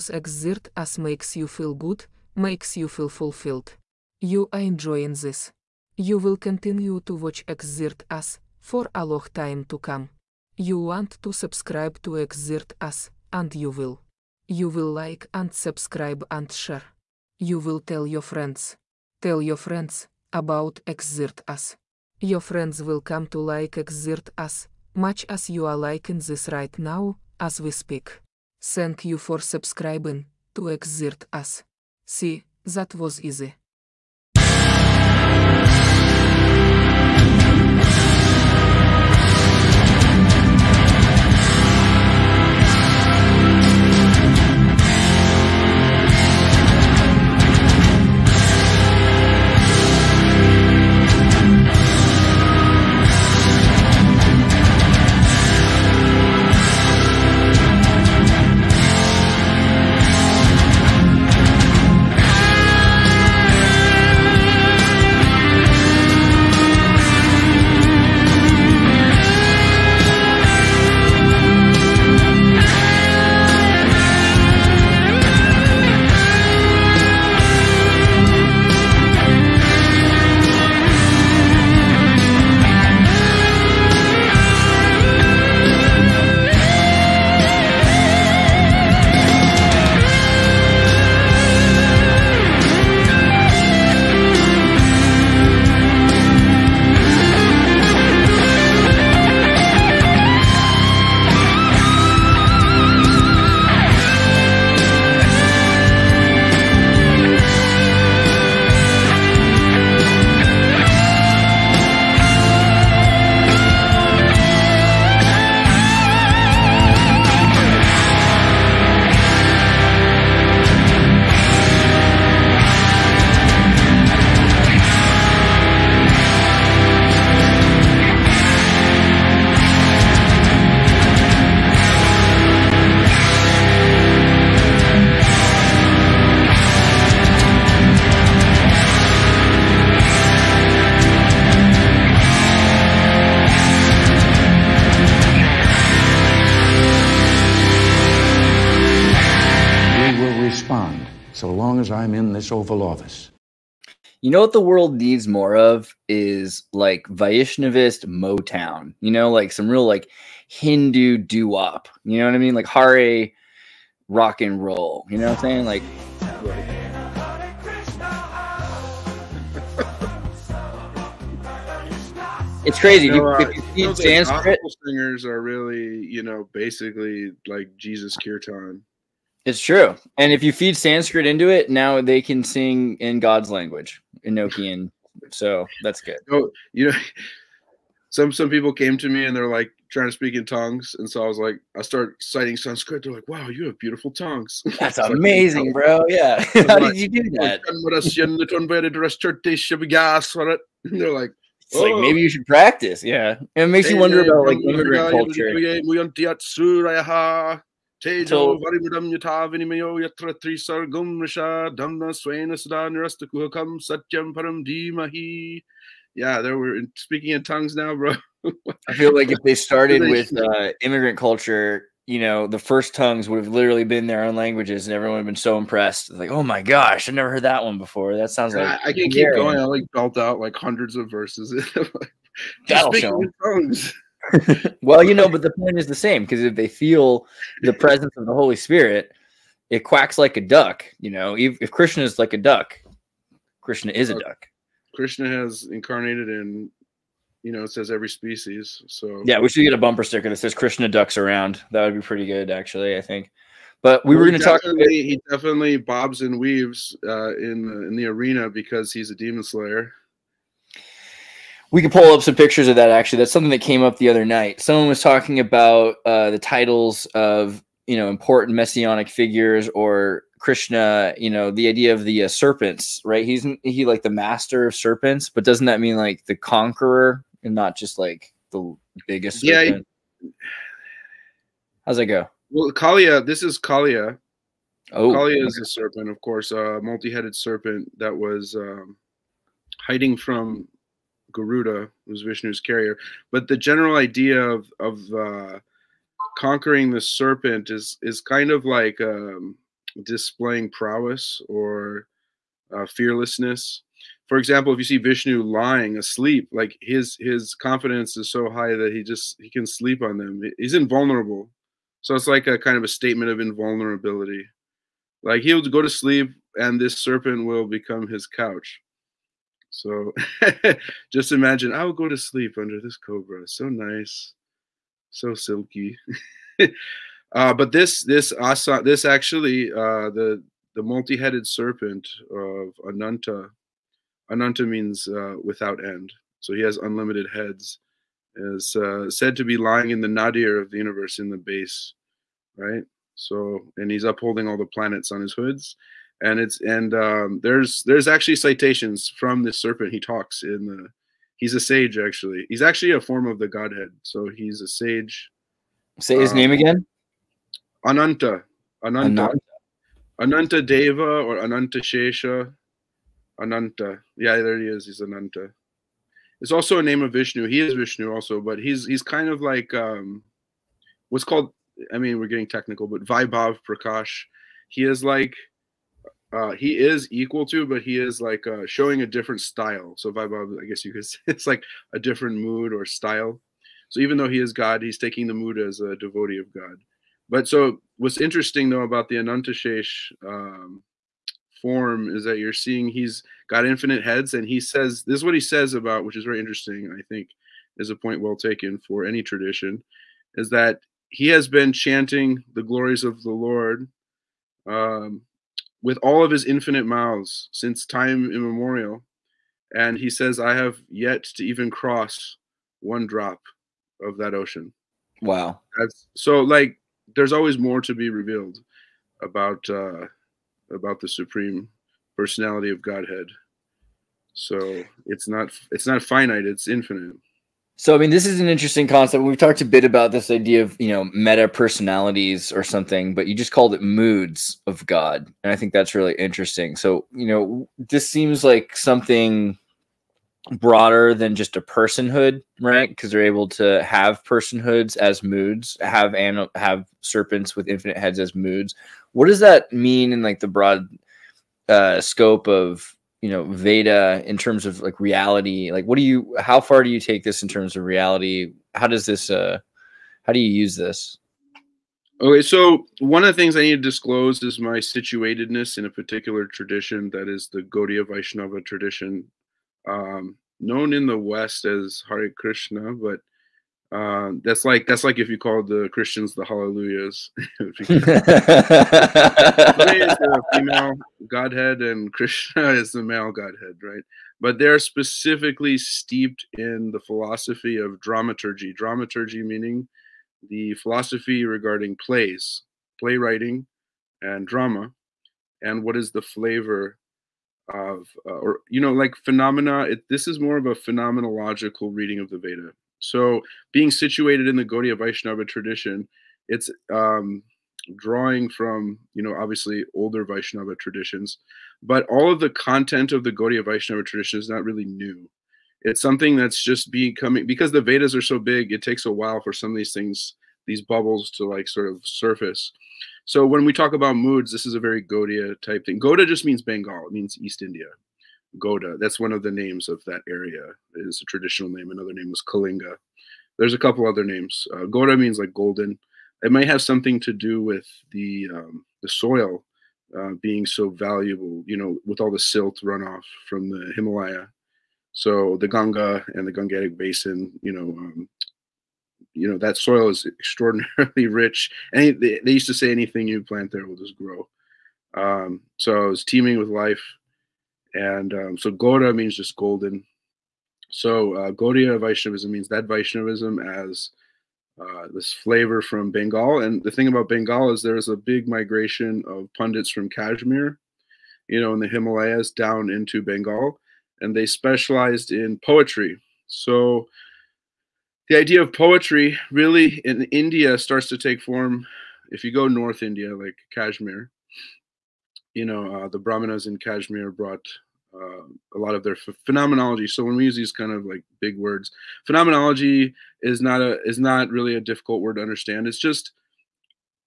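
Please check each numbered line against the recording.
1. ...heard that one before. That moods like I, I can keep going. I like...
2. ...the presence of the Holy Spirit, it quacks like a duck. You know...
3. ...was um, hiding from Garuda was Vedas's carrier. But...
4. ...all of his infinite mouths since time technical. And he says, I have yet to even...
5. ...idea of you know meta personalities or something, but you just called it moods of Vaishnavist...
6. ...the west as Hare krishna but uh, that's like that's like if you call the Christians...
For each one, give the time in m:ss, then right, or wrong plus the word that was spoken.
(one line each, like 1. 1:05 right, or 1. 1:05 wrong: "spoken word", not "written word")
1. 3:47 wrong: "sounds", not "moods"
2. 3:57 right
3. 4:48 wrong: "Vishnu", not "Vedas"
4. 6:45 wrong: "immemorial", not "technical"
5. 7:10 wrong: "God", not "Vaishnavist"
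6. 7:51 right.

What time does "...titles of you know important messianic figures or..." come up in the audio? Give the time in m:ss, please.
4:26.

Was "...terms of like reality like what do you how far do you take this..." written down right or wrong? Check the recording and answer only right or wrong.
right.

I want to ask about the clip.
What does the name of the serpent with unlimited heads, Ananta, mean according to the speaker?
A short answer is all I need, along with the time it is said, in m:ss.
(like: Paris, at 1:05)
without end, at 5:35.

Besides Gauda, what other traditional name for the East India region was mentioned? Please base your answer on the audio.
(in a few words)
Kalinga.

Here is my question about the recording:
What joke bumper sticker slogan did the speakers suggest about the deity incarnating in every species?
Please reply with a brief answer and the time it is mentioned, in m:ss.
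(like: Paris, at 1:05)
Krishna ducks around, at 4:10.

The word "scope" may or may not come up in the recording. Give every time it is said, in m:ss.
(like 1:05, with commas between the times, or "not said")
7:32.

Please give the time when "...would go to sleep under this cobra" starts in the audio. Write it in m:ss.
5:21.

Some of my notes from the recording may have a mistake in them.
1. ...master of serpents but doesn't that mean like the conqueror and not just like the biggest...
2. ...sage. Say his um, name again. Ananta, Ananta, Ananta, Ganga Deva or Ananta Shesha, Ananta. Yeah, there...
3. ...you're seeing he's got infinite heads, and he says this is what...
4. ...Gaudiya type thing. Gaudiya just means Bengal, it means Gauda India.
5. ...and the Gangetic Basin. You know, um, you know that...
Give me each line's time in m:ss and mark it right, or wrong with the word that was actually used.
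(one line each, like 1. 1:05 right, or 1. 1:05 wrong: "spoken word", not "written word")
1. 4:34 right
2. 5:54 wrong: "Ananta", not "Ganga"
3. 6:32 right
4. 8:45 wrong: "East", not "Gauda"
5. 9:06 right.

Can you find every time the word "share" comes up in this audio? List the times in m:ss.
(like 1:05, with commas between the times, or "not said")
0:16.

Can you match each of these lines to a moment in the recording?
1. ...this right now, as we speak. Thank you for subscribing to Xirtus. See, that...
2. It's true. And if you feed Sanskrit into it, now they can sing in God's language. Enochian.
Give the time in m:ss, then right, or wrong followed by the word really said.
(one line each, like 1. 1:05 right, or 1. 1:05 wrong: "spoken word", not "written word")
1. 0:26 right
2. 2:59 right.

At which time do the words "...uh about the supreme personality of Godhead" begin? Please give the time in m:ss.
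6:59.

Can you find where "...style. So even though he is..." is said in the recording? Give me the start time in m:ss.
6:22.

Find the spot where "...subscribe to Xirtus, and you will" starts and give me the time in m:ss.
0:11.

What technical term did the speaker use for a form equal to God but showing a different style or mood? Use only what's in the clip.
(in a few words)
Vaibhav Prakash.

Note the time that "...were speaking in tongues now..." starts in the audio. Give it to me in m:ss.
3:36.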